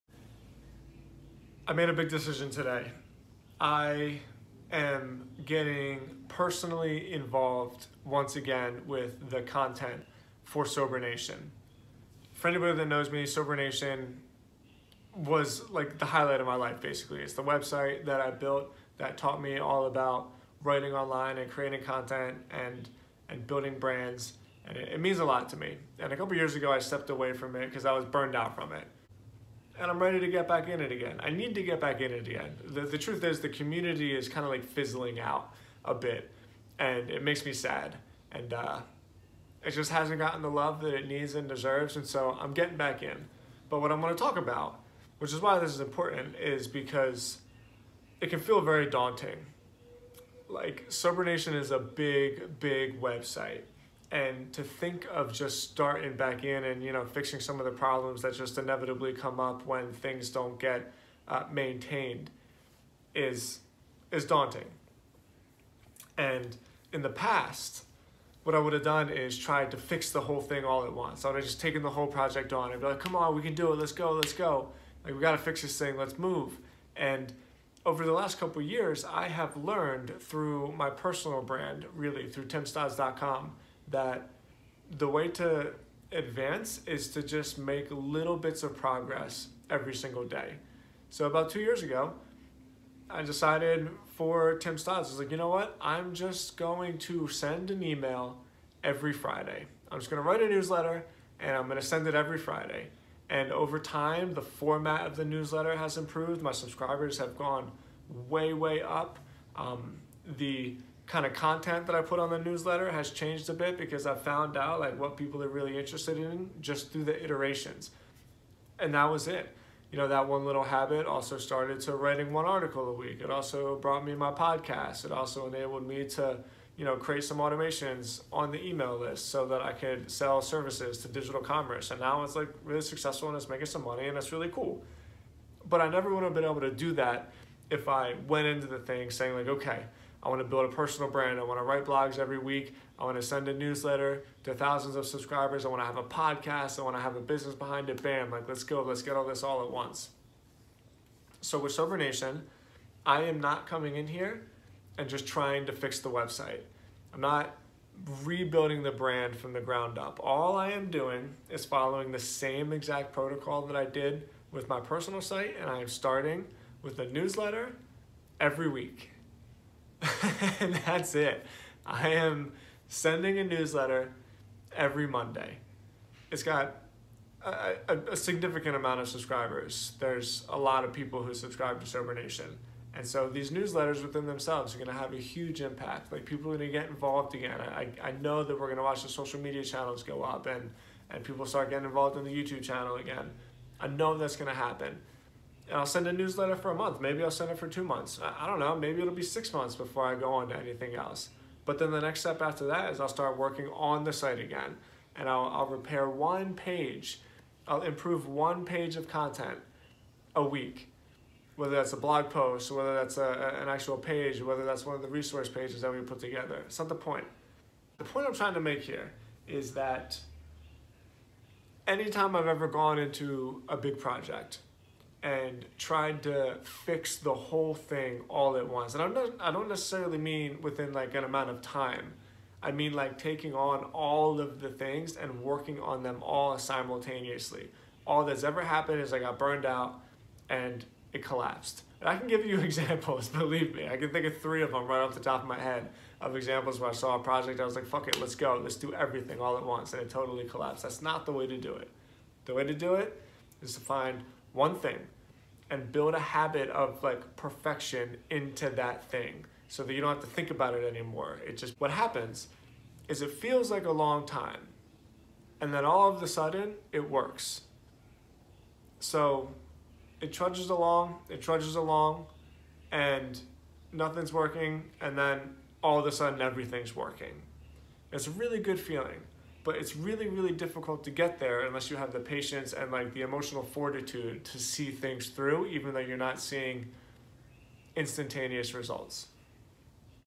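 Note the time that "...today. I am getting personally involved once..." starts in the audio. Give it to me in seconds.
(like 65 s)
2 s.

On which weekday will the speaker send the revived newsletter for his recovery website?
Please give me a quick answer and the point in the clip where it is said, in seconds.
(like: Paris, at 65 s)
Monday, at 175 s.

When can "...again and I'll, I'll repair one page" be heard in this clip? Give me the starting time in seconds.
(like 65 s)
204 s.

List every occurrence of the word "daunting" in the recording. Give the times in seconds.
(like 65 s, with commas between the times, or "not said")
48 s, 64 s.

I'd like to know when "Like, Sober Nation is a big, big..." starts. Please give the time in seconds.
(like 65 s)
50 s.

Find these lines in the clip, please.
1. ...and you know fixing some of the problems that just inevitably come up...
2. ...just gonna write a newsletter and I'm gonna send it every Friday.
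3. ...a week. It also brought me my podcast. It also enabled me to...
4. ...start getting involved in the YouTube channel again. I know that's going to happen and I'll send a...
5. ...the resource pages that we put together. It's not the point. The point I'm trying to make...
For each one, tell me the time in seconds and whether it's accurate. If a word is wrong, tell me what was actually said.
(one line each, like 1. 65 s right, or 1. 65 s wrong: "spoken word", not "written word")
1. 56 s right
2. 99 s right
3. 122 s right
4. 191 s right
5. 215 s right.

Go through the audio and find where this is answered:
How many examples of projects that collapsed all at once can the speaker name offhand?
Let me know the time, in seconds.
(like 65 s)
244 s.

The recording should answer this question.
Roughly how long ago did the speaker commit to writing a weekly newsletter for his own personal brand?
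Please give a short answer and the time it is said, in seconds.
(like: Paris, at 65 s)
2 years, at 91 s.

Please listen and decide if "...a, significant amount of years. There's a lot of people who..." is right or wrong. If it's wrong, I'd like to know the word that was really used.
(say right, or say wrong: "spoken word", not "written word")
wrong: "subscribers", not "years".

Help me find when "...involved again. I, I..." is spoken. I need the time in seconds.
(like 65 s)
186 s.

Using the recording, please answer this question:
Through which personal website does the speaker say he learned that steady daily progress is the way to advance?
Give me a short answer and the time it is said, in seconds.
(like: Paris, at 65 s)
timstodz.com, at 82 s.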